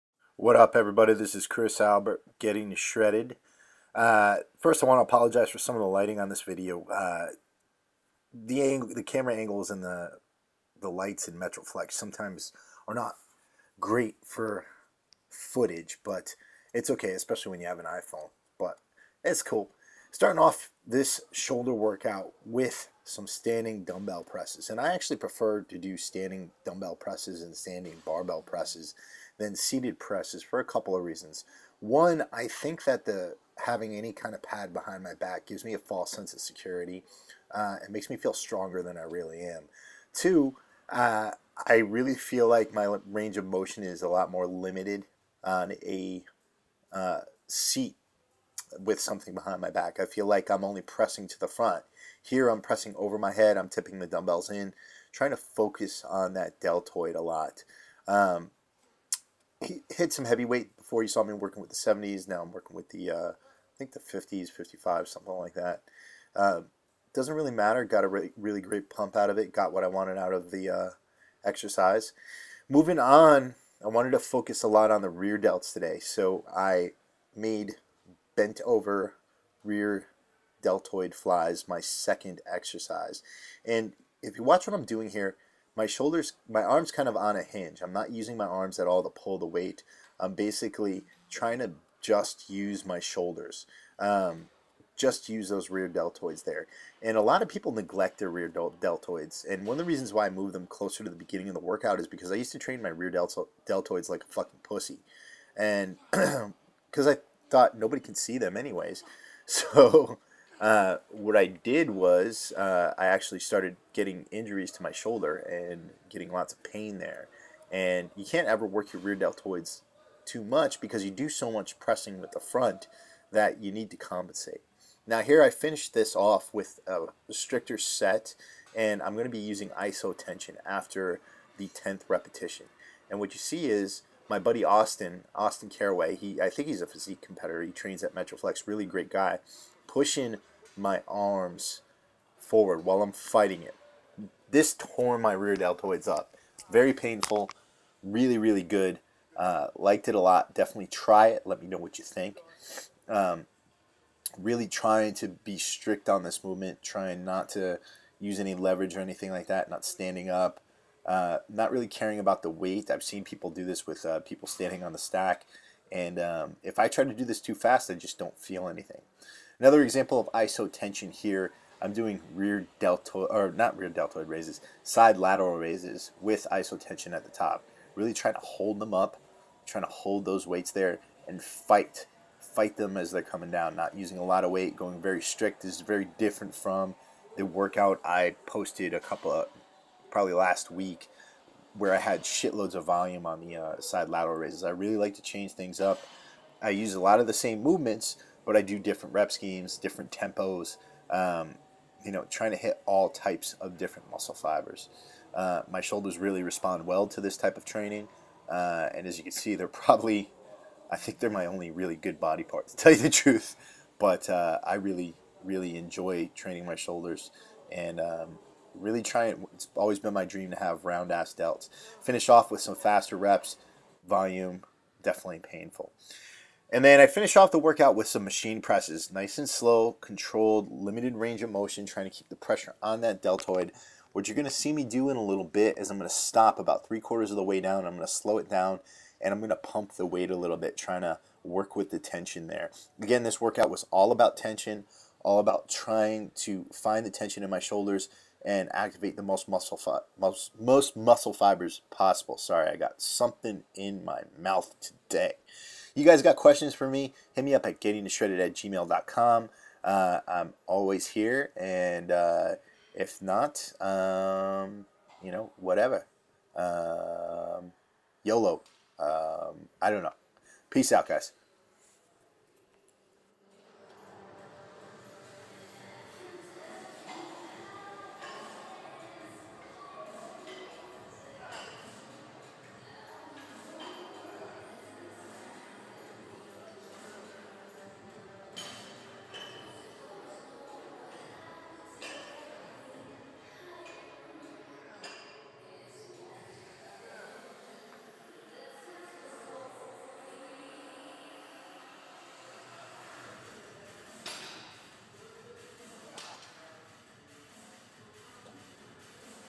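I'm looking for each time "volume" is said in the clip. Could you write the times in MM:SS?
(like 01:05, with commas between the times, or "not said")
03:12, 03:44.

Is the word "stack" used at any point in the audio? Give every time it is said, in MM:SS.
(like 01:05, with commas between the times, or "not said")
02:44.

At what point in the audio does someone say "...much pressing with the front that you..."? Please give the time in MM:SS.
02:01.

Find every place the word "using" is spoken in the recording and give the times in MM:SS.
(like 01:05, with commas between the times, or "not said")
01:28, 02:09, 03:03.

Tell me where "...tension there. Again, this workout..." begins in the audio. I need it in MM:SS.
04:01.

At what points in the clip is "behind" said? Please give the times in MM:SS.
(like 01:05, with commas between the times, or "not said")
00:34, 00:49.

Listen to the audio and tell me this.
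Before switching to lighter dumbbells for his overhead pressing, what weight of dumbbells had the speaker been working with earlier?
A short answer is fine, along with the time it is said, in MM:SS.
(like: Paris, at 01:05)
70s, at 01:01.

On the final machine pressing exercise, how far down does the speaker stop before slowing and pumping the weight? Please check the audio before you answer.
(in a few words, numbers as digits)
three quarters.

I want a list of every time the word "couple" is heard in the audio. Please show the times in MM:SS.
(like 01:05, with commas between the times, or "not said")
00:30, 03:08.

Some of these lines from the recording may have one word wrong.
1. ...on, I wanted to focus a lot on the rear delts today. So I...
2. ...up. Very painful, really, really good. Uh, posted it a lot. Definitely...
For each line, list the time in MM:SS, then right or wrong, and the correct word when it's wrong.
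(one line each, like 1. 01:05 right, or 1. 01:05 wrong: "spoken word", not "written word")
1. 01:12 right
2. 02:26 wrong: "liked", not "posted".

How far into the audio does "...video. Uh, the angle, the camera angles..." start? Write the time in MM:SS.
00:06.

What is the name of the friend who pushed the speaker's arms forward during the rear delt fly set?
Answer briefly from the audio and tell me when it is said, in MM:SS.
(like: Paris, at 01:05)
Austin Caraway, at 02:15.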